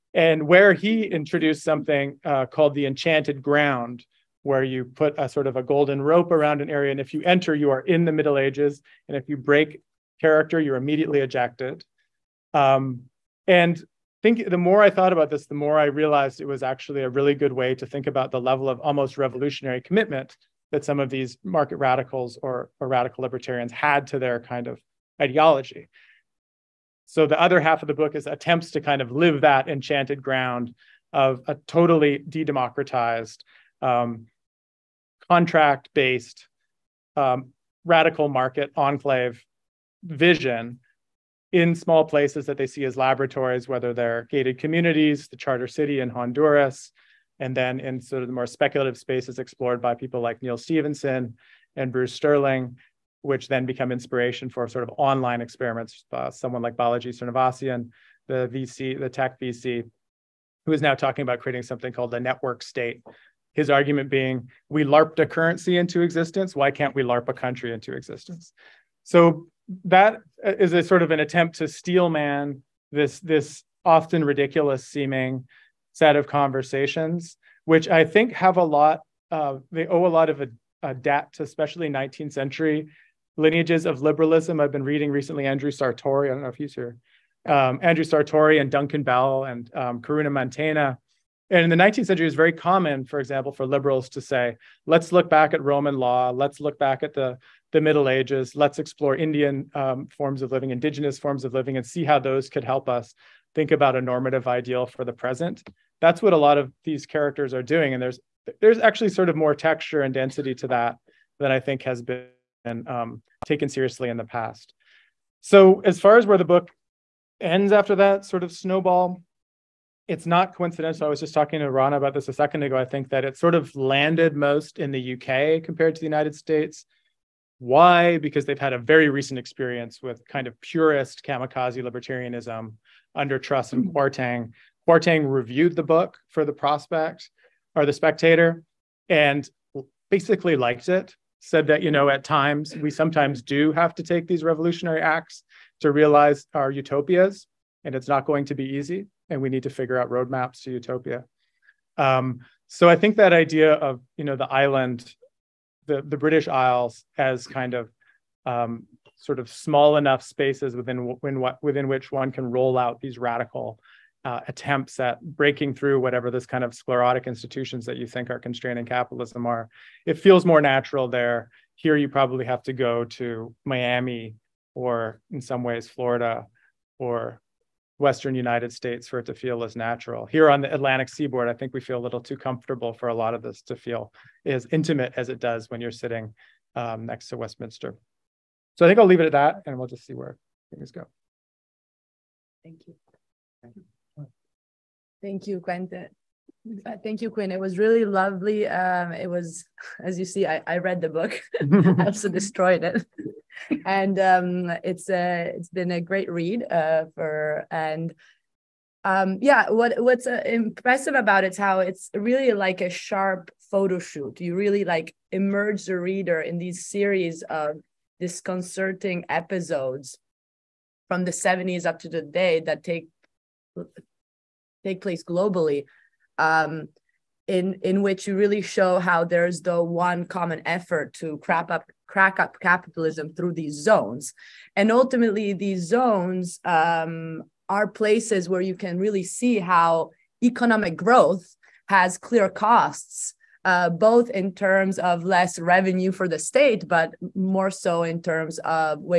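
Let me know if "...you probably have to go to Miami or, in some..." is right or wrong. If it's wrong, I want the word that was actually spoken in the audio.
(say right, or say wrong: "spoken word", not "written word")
right.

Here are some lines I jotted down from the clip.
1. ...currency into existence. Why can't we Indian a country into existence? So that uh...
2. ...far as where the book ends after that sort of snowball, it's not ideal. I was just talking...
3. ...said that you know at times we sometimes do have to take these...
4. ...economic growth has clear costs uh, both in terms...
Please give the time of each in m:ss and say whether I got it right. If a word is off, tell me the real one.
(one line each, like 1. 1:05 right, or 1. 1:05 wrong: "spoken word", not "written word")
1. 1:05 wrong: "LARP", not "Indian"
2. 1:55 wrong: "coincidental", not "ideal"
3. 2:21 right
4. 4:00 right.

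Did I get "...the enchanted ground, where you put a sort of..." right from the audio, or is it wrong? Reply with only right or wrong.
right.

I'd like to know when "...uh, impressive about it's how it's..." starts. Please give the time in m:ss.
3:30.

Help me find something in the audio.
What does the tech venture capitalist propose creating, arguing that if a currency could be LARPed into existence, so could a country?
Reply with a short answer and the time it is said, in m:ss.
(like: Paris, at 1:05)
The network state, at 1:02.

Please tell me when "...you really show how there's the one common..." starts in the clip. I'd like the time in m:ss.
3:48.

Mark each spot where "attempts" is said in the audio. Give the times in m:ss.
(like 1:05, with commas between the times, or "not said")
0:28, 1:11, 2:44.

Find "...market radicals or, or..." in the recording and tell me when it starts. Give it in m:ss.
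0:21.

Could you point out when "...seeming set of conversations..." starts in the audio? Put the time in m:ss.
1:14.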